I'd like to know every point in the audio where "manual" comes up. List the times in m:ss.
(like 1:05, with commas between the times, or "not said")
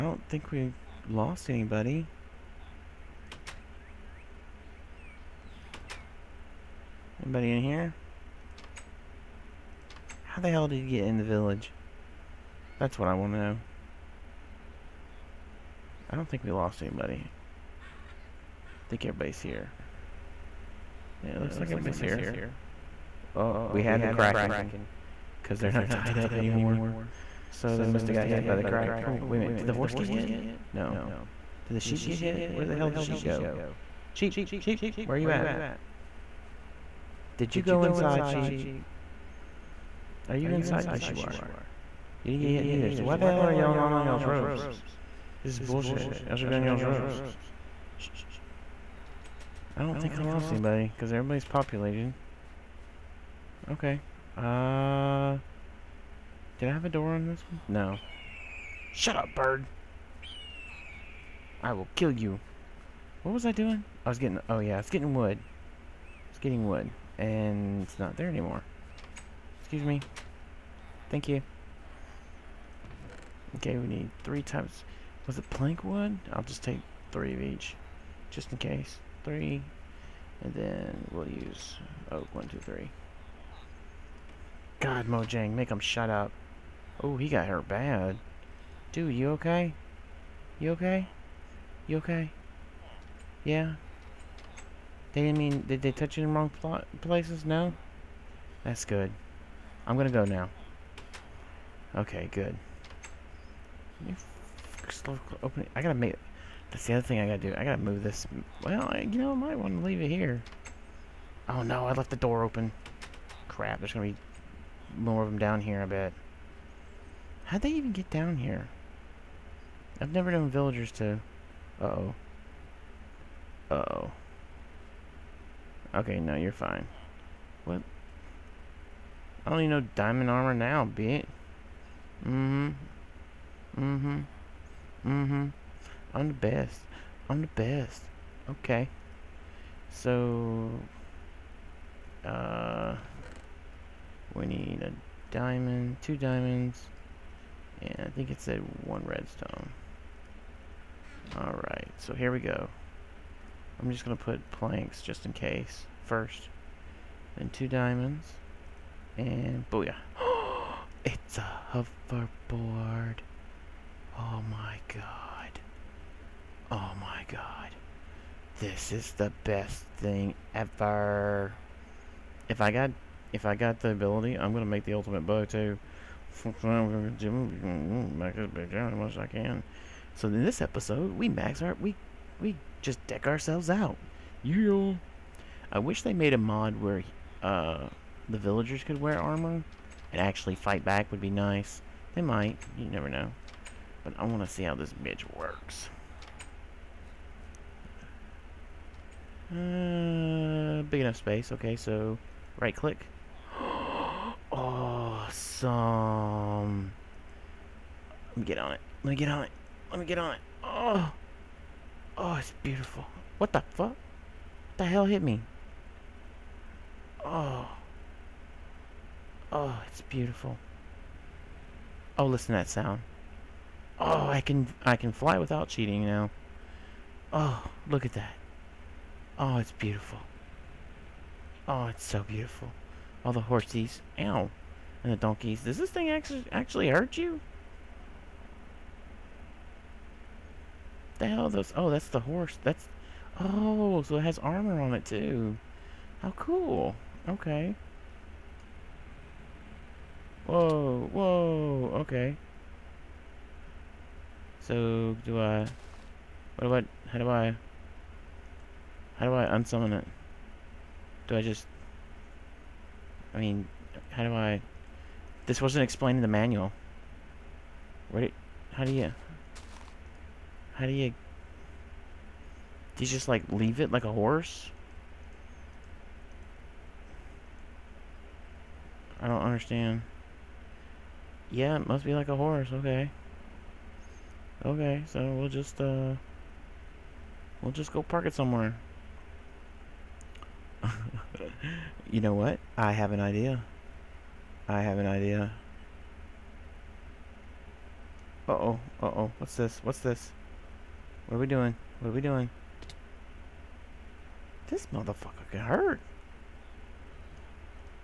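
4:26.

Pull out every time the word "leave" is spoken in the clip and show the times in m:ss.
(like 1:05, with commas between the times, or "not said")
1:49, 4:33.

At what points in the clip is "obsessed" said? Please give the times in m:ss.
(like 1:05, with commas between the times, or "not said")
not said.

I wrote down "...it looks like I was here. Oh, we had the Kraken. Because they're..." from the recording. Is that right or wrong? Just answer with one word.
right.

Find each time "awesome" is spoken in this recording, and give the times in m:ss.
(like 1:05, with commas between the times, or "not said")
3:24.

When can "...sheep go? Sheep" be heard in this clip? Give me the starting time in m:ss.
0:32.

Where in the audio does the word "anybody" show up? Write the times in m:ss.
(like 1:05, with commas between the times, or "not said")
0:01, 0:07, 0:16, 0:50.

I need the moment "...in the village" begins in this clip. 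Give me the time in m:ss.
0:11.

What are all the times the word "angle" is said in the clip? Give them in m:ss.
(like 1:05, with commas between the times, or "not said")
not said.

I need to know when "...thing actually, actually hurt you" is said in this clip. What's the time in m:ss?
3:55.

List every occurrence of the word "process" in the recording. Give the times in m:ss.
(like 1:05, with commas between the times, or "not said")
not said.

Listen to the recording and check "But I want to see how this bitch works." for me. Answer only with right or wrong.
right.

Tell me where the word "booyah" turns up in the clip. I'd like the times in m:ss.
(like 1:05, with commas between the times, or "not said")
2:39.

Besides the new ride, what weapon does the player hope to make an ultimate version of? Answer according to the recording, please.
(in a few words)
bow.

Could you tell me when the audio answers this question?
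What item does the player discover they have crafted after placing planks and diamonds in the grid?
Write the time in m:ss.
2:41.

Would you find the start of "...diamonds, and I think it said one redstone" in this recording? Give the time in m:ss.
2:26.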